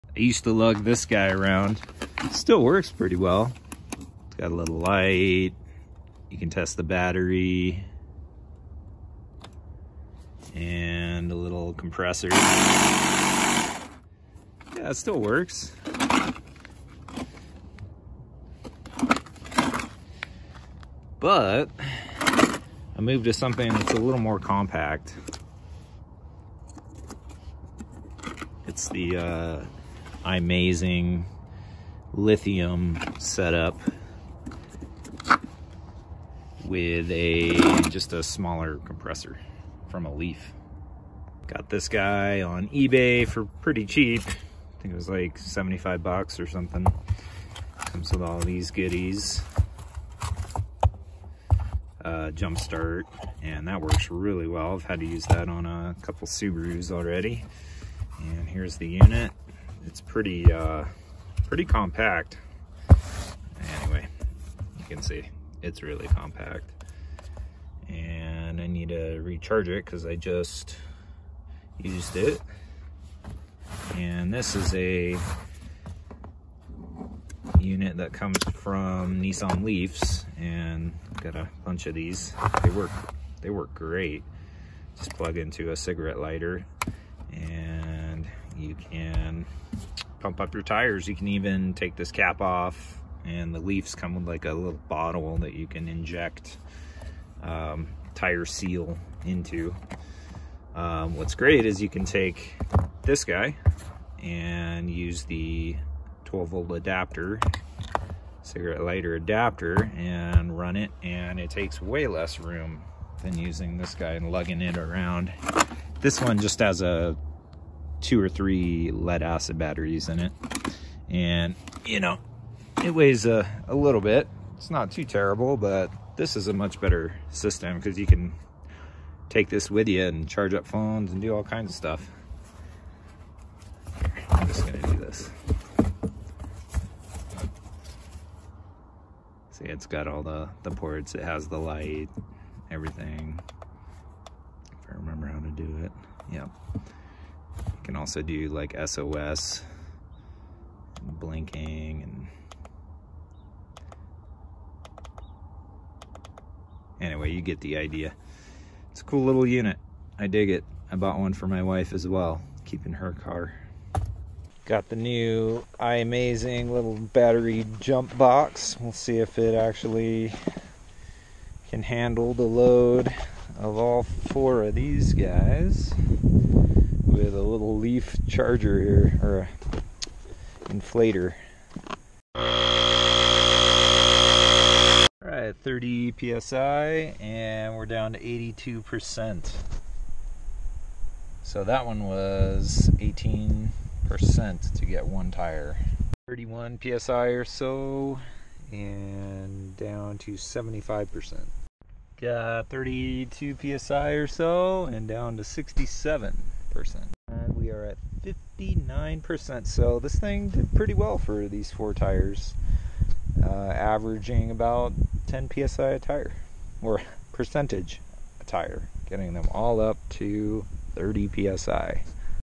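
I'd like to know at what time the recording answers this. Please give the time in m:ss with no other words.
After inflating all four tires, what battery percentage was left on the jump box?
3:28.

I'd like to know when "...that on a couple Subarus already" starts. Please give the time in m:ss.
0:55.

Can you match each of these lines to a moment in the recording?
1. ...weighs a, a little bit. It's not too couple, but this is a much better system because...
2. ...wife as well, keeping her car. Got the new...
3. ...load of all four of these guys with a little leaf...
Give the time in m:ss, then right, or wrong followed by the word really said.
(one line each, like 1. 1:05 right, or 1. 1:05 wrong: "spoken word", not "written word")
1. 2:02 wrong: "terrible", not "couple"
2. 2:41 right
3. 2:52 right.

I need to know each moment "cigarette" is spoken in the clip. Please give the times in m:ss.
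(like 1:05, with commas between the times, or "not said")
1:25, 1:48.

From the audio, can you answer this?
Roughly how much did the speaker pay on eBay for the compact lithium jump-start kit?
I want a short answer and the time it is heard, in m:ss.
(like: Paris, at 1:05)
$75, at 0:45.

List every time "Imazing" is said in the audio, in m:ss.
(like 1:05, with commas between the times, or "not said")
0:30, 2:45.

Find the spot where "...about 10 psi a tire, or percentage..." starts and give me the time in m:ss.
3:34.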